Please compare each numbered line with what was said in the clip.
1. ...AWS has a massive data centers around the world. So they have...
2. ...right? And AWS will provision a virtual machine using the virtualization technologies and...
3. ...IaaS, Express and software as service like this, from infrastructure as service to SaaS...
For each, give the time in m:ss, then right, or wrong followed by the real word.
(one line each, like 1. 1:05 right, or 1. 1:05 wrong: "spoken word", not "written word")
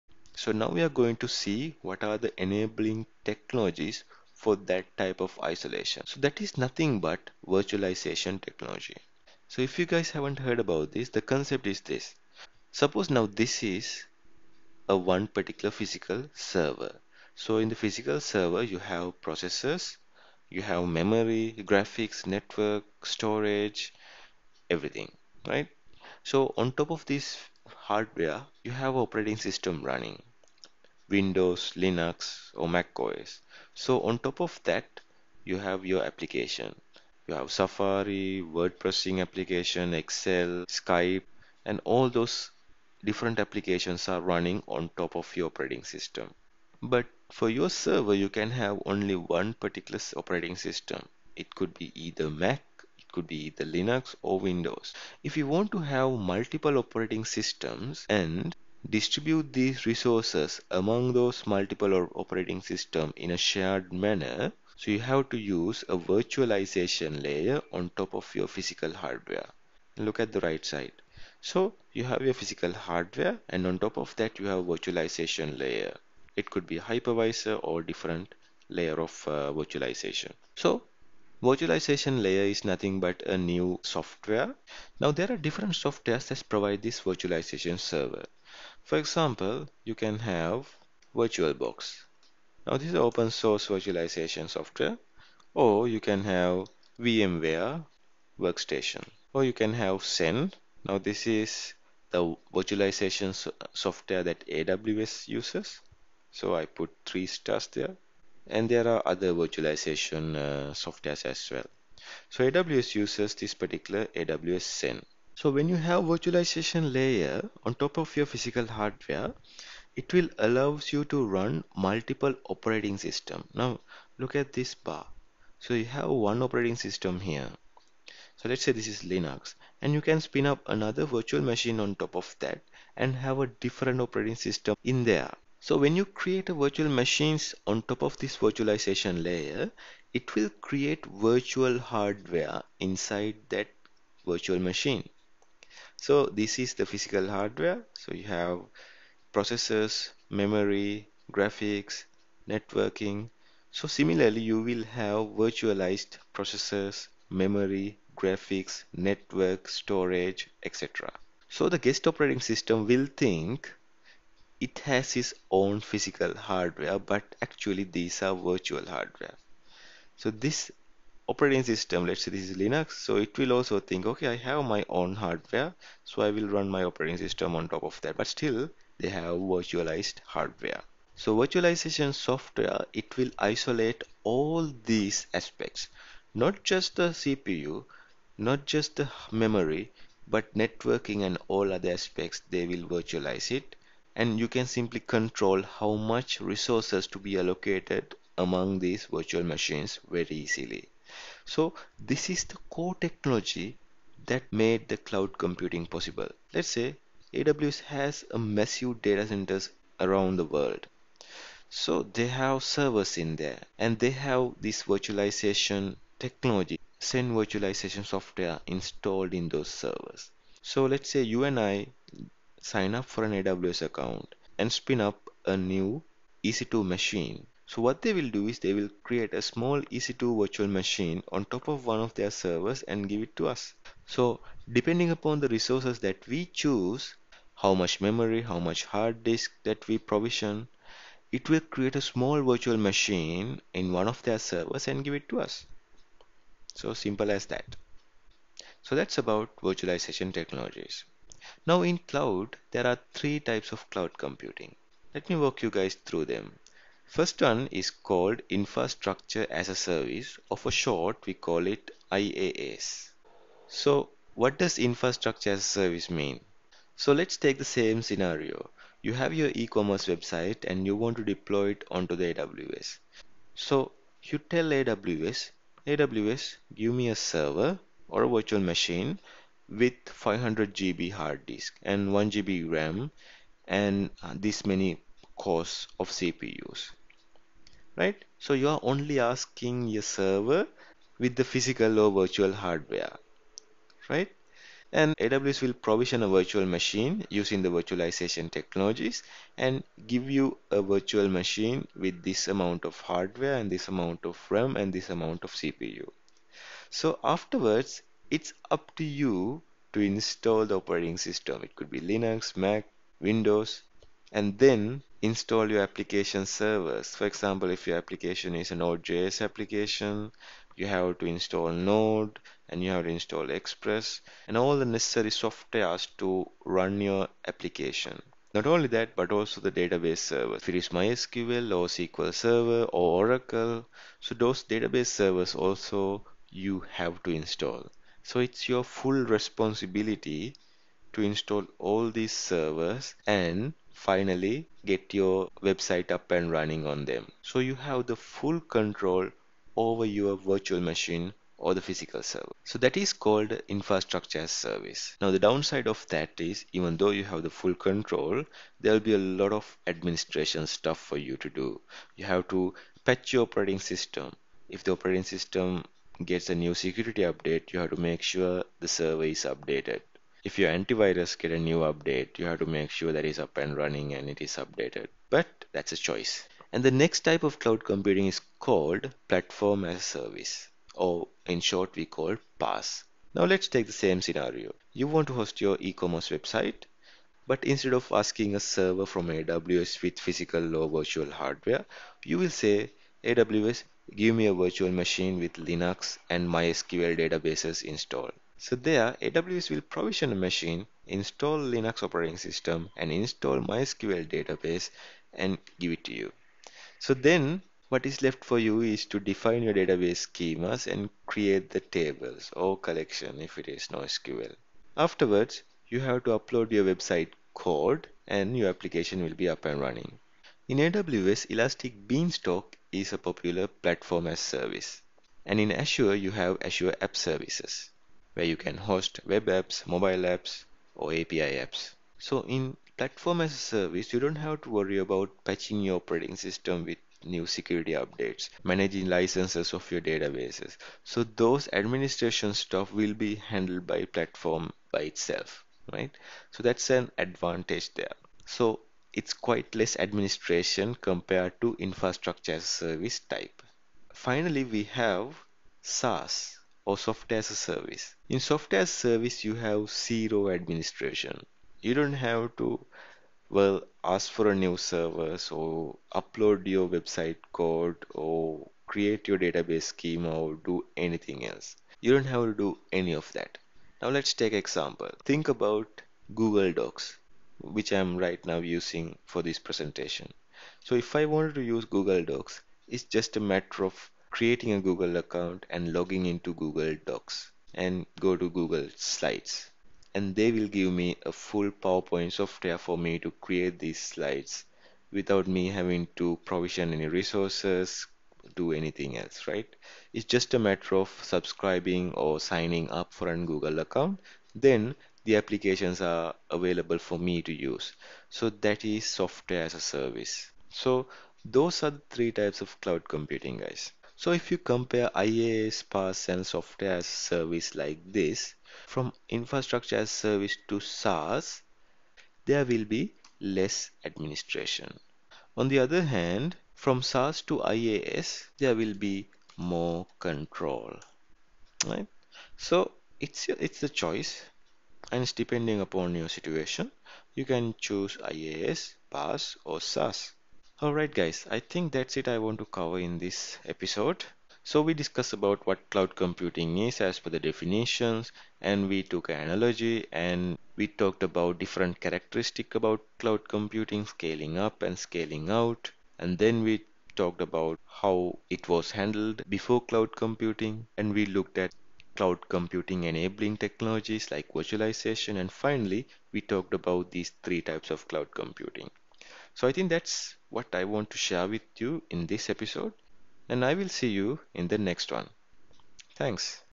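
1. 3:27 right
2. 4:54 right
3. 8:35 wrong: "PaaS", not "Express".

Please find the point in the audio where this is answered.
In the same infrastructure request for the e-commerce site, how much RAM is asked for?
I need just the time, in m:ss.
4:42.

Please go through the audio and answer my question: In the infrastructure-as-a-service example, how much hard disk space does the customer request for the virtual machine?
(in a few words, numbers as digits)
500 GB.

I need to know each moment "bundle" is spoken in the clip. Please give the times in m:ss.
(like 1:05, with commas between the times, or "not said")
not said.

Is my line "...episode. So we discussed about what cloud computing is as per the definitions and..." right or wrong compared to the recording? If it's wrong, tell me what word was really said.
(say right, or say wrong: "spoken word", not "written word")
right.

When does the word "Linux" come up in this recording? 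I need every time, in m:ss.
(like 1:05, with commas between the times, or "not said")
0:31, 0:53, 2:09, 2:52, 5:12, 6:35, 6:41.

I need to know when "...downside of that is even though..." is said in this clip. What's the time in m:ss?
5:55.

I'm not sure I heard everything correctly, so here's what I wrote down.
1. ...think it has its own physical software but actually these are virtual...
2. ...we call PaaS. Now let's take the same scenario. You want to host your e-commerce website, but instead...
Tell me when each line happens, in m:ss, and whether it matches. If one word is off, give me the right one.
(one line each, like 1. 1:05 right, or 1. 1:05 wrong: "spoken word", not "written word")
1. 2:43 wrong: "hardware", not "software"
2. 6:21 right.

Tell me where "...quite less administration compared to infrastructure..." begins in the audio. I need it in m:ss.
7:29.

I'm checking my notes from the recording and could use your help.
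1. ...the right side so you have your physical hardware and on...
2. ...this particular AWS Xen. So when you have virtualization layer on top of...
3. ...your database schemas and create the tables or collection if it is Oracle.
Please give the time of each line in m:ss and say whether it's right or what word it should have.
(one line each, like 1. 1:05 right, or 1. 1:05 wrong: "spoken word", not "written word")
1. 1:10 right
2. 1:53 right
3. 6:49 wrong: "NoSQL", not "Oracle".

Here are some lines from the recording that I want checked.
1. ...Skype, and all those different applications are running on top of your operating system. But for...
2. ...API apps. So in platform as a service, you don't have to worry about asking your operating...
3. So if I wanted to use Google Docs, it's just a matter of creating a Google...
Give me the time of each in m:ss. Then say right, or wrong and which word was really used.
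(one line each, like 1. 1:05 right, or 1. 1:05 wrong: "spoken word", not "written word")
1. 0:40 right
2. 7:11 wrong: "patching", not "asking"
3. 8:00 right.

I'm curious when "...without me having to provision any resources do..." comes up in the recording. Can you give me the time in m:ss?
8:15.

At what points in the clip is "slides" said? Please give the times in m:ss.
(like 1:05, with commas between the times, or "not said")
8:08, 8:14.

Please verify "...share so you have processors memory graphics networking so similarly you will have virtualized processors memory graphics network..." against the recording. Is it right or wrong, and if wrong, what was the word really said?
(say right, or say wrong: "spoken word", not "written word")
wrong: "hardware", not "share".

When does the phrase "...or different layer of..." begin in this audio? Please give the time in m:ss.
1:17.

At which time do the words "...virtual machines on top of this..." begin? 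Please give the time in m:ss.
2:16.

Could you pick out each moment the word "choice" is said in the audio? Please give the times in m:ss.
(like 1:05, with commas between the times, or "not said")
6:15, 8:54.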